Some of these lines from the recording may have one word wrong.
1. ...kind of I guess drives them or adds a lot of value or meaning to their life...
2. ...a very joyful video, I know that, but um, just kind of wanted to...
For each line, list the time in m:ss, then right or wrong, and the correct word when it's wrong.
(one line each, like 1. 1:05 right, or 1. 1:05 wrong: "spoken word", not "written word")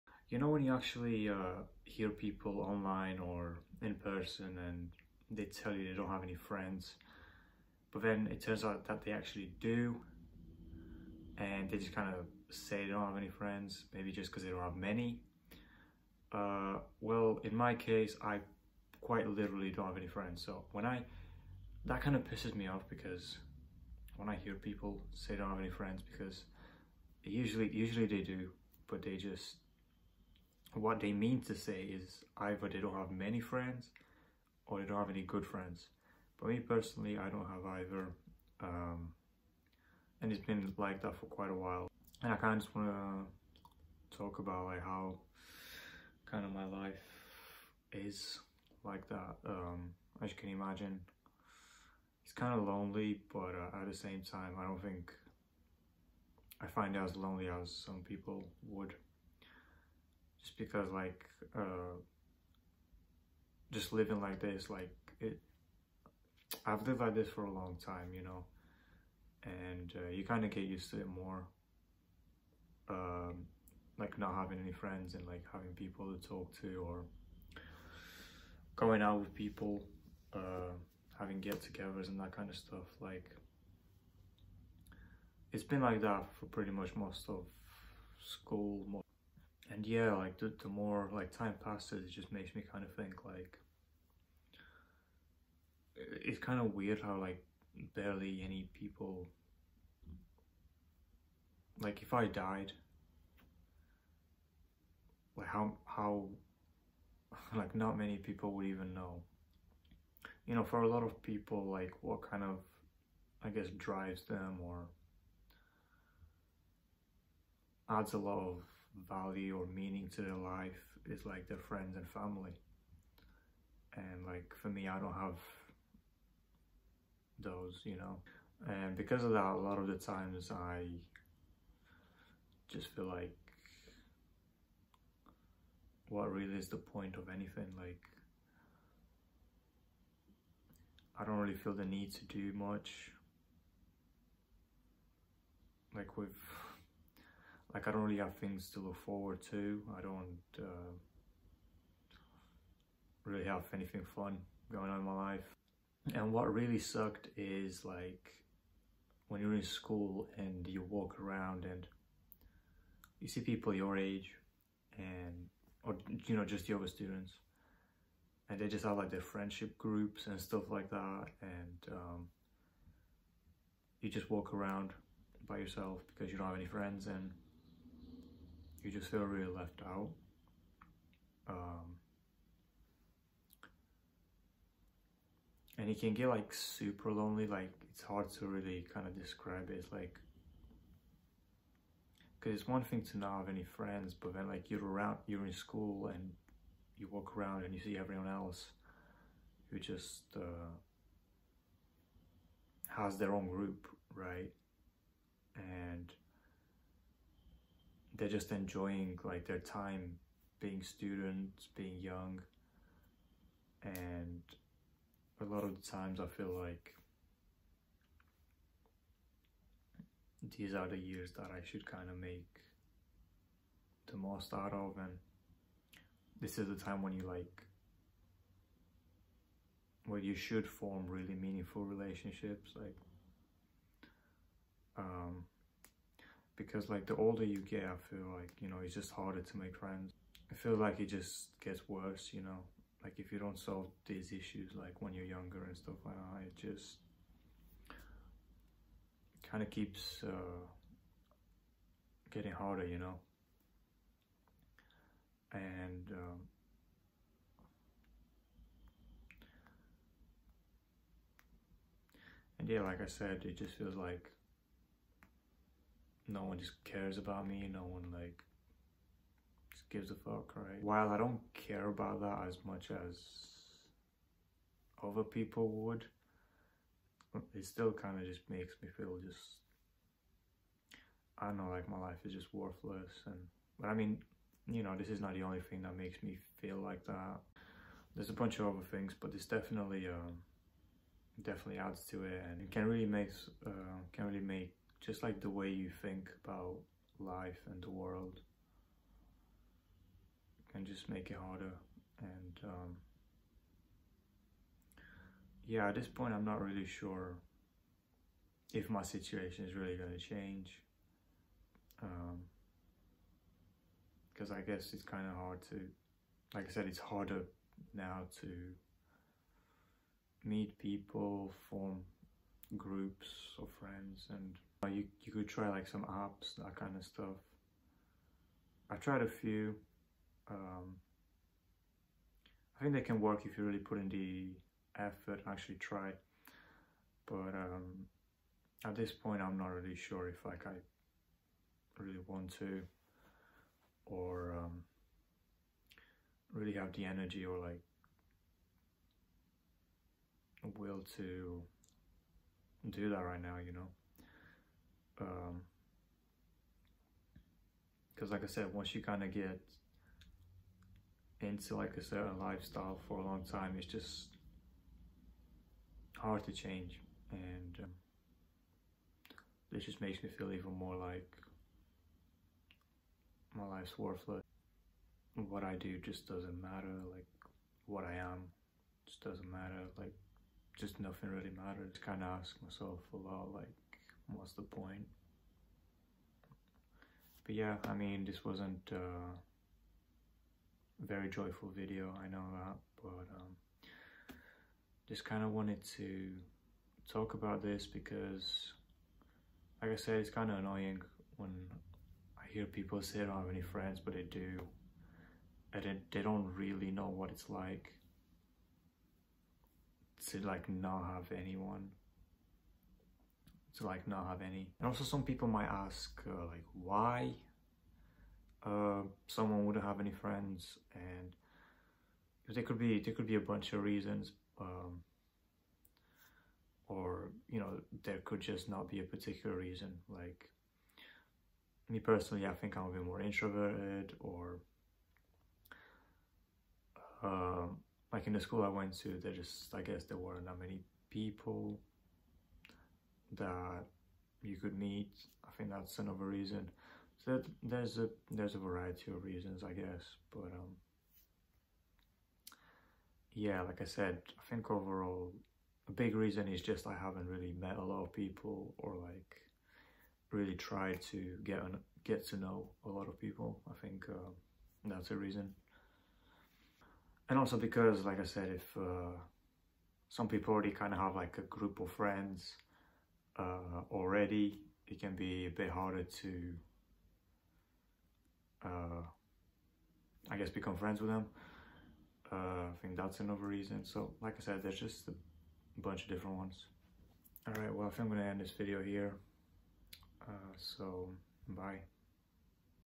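1. 1:52 right
2. 6:29 right.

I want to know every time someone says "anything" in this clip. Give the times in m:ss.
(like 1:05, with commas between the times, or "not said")
2:17, 2:33.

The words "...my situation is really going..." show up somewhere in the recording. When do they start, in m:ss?
5:08.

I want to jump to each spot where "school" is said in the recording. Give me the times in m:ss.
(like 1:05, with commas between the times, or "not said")
1:28, 2:39, 3:15, 7:18.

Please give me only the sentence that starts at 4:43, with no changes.
And, but I mean, you know, this is not the only thing that makes me feel like that.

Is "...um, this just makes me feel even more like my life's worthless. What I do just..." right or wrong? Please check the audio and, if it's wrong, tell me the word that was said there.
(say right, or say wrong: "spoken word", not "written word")
right.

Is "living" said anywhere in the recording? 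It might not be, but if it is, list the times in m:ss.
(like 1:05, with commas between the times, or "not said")
1:03.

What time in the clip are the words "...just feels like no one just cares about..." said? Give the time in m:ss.
4:23.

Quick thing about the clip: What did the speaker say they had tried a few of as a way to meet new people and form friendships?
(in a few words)
apps.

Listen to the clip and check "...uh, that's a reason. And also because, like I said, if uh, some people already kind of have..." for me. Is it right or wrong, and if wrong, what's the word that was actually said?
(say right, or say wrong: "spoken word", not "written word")
right.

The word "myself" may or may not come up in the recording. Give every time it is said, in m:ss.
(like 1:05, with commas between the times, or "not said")
6:22.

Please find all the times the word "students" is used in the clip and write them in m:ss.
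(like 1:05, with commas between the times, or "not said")
2:46, 3:30.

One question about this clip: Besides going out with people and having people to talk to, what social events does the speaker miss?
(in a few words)
get-togethers.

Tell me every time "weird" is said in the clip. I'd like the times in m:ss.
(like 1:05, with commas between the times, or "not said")
1:36.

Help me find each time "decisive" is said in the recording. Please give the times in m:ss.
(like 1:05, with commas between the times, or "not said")
not said.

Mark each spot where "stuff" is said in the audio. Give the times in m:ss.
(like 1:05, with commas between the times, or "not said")
1:22, 2:50, 4:05, 5:27.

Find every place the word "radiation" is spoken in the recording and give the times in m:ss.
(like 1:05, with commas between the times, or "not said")
not said.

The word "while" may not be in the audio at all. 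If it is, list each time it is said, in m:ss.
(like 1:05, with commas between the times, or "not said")
0:41, 4:30.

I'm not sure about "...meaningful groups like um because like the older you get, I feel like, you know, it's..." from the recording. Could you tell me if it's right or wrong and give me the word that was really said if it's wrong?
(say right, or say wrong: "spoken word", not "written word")
wrong: "relationships", not "groups".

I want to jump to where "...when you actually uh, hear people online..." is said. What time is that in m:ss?
0:00.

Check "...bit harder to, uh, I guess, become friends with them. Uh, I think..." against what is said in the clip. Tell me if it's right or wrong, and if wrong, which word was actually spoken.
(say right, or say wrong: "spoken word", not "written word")
right.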